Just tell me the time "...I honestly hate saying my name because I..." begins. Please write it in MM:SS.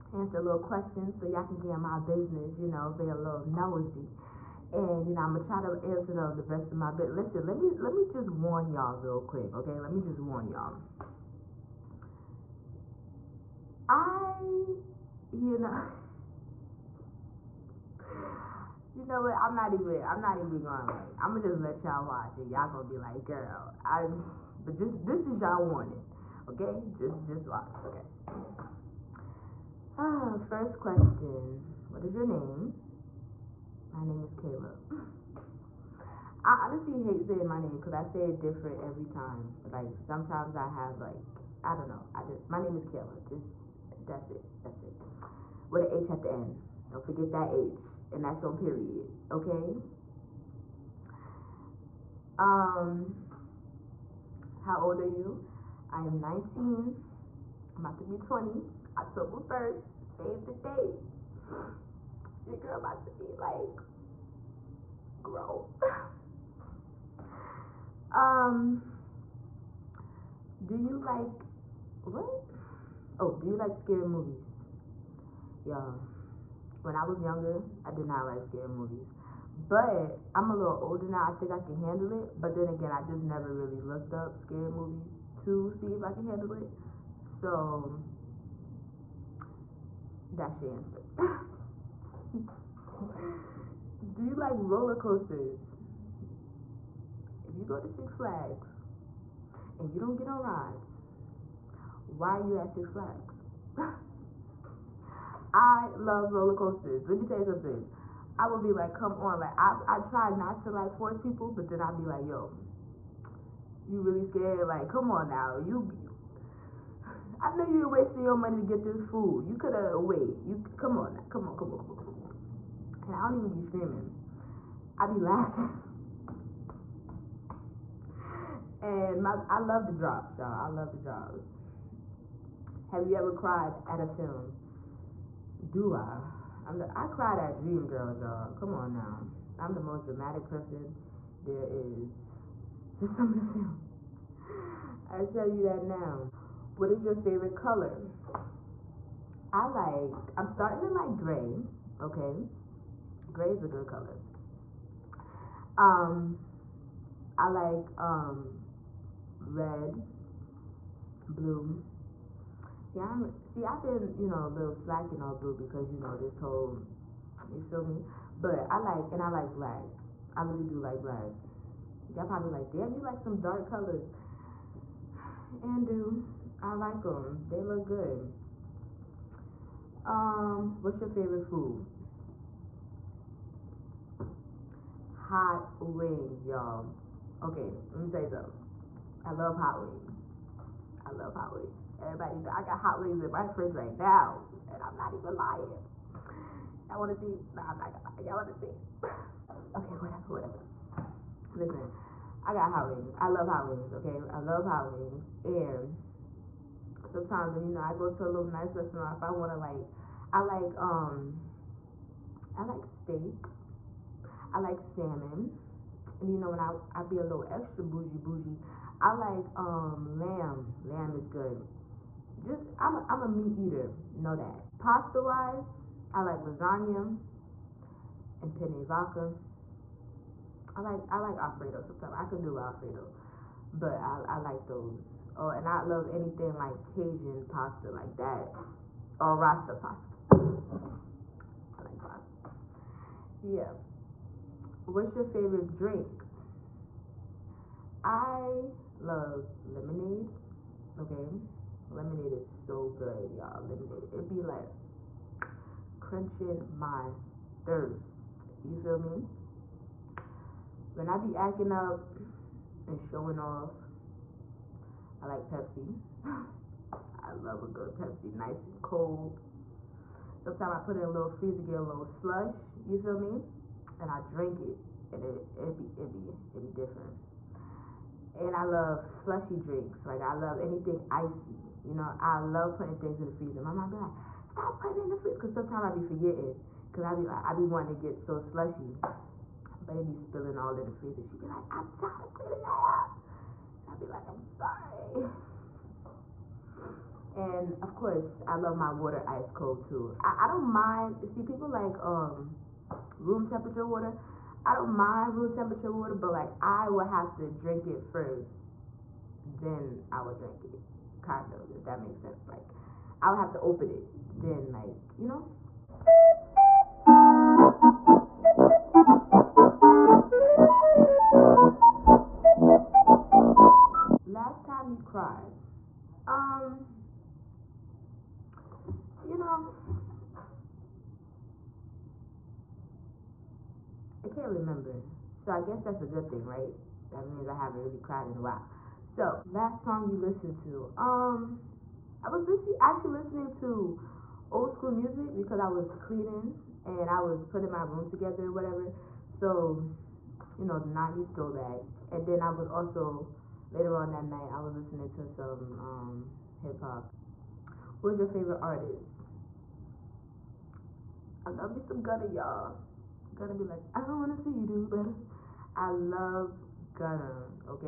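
00:36.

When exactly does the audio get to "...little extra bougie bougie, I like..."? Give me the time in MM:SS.
03:37.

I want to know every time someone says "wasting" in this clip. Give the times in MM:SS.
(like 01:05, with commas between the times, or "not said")
01:57.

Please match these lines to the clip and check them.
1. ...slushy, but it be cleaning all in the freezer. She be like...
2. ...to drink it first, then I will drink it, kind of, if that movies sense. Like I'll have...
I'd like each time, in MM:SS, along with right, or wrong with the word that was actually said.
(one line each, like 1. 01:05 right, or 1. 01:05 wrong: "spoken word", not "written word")
1. 04:48 wrong: "spilling", not "cleaning"
2. 05:07 wrong: "makes", not "movies".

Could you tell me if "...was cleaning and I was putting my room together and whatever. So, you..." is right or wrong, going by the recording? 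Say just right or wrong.
right.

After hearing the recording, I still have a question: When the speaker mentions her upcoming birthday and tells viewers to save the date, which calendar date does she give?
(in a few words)
October 1st.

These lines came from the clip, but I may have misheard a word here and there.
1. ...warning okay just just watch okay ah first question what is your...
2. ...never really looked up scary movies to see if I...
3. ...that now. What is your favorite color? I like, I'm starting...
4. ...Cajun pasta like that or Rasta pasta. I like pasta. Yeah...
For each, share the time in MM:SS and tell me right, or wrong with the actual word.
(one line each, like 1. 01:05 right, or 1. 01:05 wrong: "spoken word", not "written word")
1. 00:25 right
2. 01:23 right
3. 02:25 right
4. 03:56 right.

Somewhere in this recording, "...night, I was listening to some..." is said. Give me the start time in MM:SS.
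05:54.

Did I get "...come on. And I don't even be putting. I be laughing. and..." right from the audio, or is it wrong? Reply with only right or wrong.
wrong.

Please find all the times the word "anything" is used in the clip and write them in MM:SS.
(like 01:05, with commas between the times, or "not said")
03:56, 04:40.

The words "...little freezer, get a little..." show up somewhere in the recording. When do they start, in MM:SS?
04:31.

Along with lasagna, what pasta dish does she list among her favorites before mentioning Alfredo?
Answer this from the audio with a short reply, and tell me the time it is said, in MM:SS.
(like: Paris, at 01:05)
Penne vodka, at 03:48.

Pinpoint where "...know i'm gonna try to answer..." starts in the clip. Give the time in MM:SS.
00:05.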